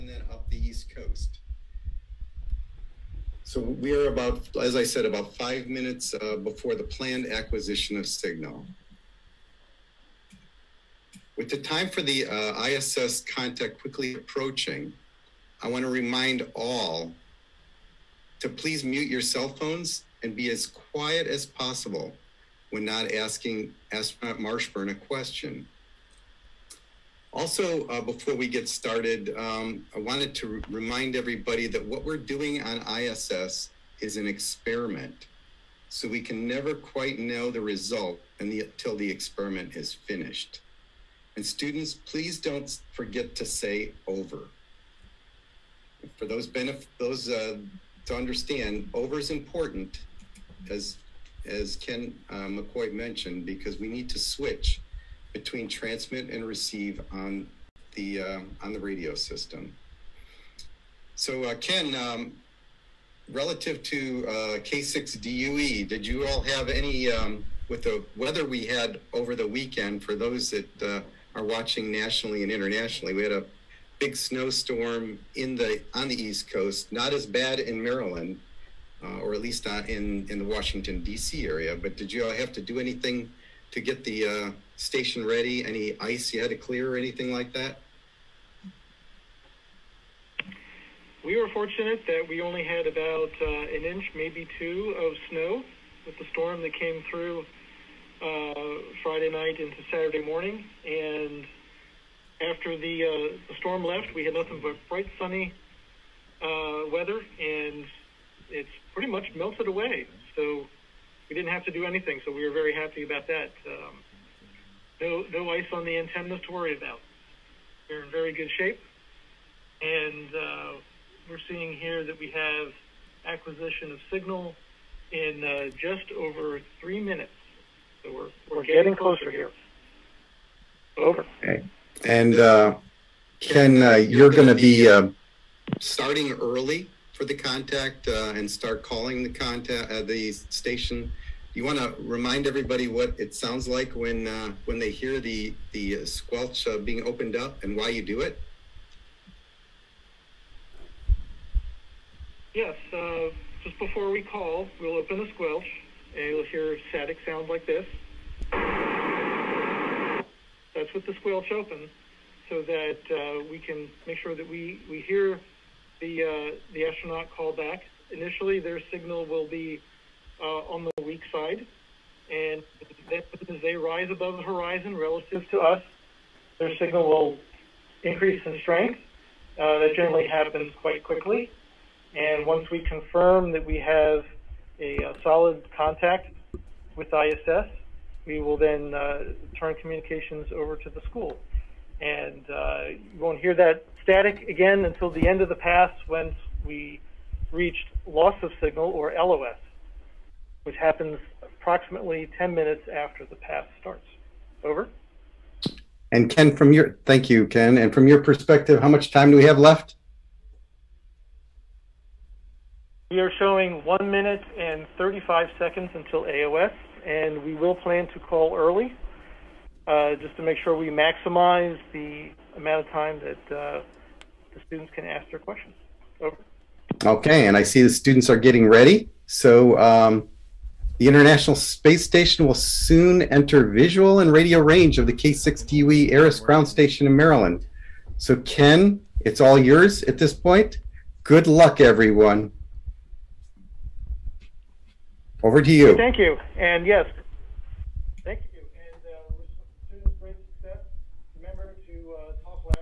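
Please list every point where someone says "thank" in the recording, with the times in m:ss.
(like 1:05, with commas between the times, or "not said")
3:27, 4:05.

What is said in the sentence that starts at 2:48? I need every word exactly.
Initially, their signal will be uh, on the weak side.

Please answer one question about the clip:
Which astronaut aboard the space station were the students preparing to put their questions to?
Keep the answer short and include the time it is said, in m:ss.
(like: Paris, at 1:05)
Marshburn, at 0:24.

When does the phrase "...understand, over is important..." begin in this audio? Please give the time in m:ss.
0:48.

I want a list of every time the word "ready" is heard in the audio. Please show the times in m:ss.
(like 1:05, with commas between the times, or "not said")
1:25, 3:48.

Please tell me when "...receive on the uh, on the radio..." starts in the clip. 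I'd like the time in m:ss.
0:56.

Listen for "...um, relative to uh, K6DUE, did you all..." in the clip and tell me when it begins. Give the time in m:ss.
1:01.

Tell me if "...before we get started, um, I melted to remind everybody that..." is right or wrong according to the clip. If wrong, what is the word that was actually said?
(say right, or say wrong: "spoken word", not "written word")
wrong: "wanted", not "melted".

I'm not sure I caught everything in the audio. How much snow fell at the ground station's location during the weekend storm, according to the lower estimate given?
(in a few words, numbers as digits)
an inch.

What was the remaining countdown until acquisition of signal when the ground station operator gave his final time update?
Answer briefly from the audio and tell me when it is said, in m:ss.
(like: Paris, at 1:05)
1 minute and 35 seconds, at 3:33.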